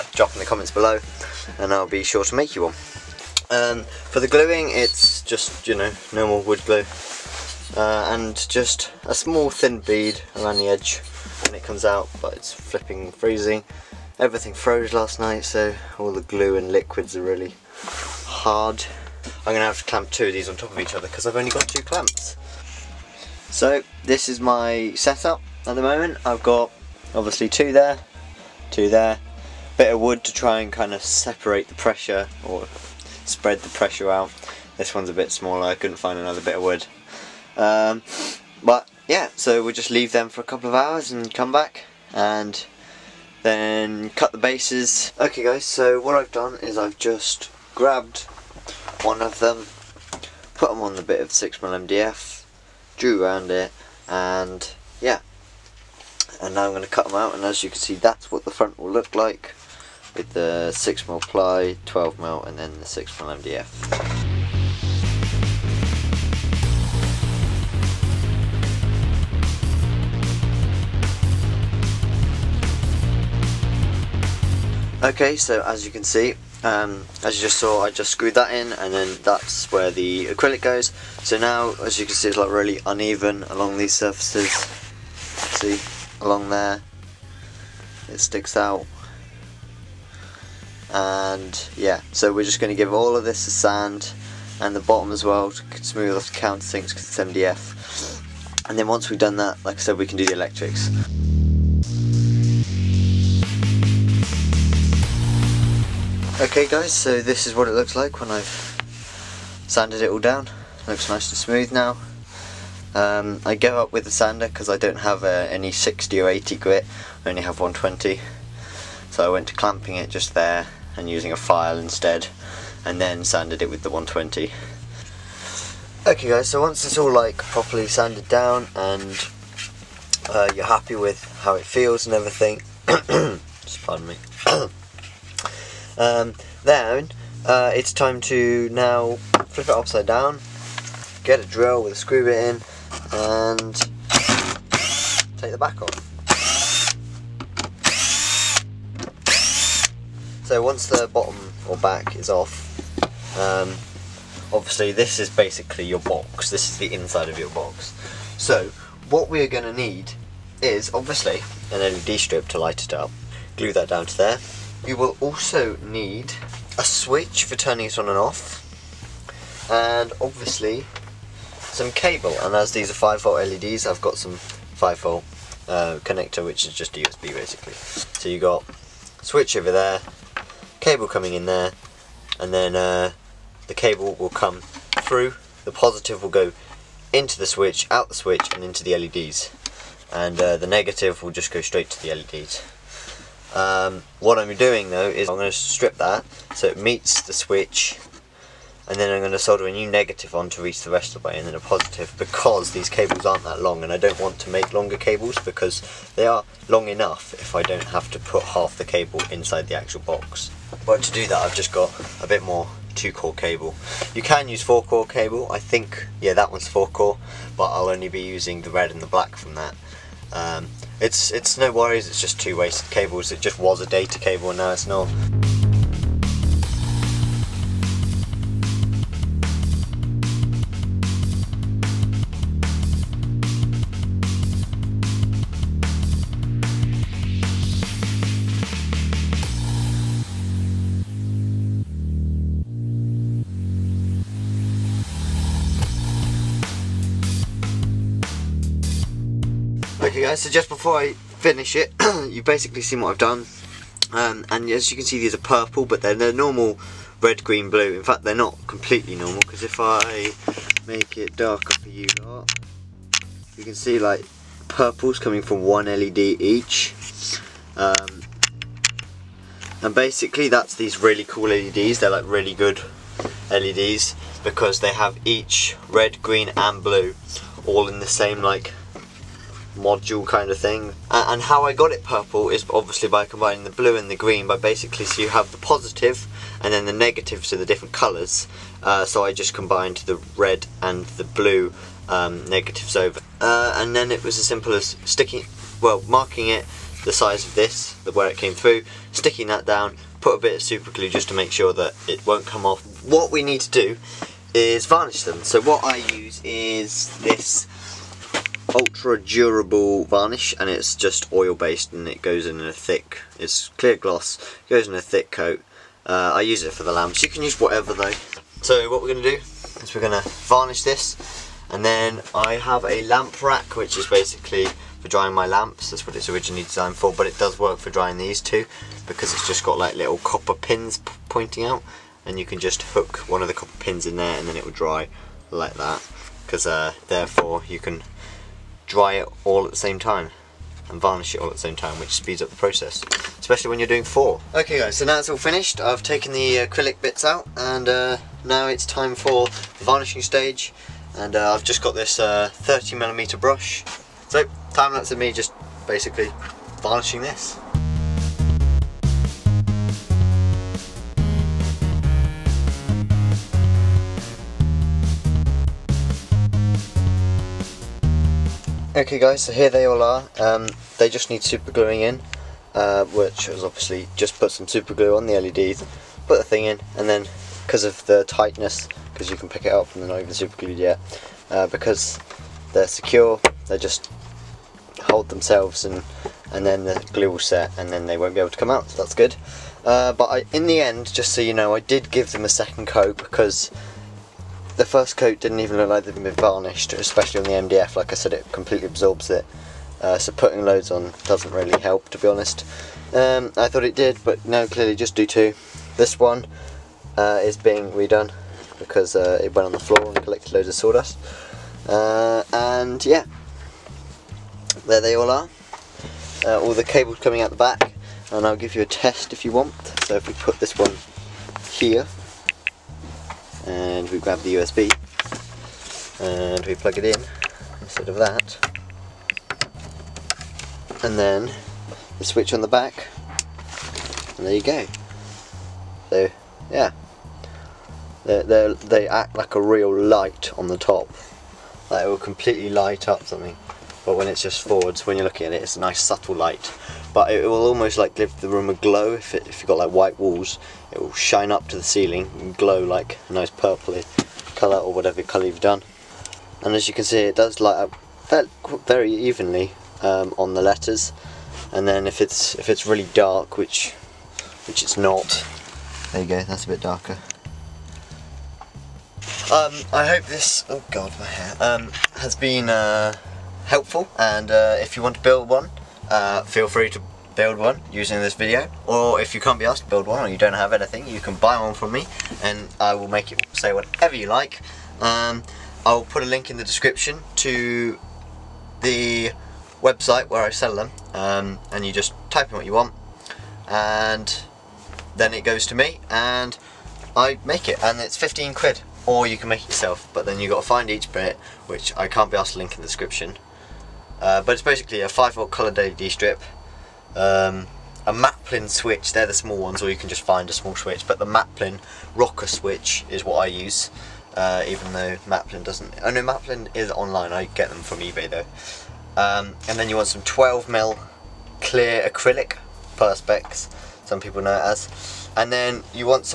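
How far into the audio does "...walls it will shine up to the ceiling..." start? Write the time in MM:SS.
07:30.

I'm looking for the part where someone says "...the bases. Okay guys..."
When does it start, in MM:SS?
00:44.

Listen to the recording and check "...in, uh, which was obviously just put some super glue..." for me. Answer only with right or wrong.
right.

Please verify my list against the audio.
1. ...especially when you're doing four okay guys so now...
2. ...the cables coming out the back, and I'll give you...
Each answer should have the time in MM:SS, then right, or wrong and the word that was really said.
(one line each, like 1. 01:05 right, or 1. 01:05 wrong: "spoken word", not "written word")
1. 05:43 right
2. 06:56 right.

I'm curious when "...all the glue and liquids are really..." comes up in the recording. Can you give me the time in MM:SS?
00:15.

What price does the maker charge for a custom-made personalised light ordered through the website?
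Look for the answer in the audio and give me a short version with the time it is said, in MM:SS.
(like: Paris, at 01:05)
15 quid, at 08:18.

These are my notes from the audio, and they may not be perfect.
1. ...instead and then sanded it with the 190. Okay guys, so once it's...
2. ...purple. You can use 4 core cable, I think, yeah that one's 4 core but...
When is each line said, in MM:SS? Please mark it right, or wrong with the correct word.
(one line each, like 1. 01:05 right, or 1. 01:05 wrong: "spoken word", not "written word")
1. 02:01 wrong: "120", not "190"
2. 03:33 wrong: "cable", not "purple".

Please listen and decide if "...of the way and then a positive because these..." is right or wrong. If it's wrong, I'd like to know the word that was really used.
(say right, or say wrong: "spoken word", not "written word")
right.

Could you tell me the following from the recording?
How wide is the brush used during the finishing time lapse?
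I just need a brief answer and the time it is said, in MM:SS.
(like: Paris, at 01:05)
30 millimeter, at 05:52.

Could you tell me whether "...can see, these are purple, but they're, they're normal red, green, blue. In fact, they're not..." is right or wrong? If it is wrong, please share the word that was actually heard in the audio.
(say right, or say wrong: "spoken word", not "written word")
right.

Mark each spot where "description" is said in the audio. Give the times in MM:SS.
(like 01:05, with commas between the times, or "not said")
08:06, 08:22.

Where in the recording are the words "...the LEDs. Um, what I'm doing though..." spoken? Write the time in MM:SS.
03:12.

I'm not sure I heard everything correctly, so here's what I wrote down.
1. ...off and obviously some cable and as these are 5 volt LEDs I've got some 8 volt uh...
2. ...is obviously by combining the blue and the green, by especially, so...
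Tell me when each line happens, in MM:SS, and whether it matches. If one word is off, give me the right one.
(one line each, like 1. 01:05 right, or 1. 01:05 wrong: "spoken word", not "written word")
1. 02:48 wrong: "5", not "8"
2. 04:42 wrong: "basically", not "especially".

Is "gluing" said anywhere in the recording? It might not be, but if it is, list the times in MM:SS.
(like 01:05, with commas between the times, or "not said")
00:04, 06:11.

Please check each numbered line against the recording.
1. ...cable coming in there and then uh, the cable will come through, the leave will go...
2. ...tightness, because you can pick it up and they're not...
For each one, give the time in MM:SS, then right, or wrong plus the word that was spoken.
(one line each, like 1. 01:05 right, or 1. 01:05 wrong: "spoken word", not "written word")
1. 03:00 wrong: "positive", not "leave"
2. 06:18 right.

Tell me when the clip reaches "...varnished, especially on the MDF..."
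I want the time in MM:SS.
06:36.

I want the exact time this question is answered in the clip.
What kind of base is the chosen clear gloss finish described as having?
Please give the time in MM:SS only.
05:11.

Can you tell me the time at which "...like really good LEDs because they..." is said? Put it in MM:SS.
04:32.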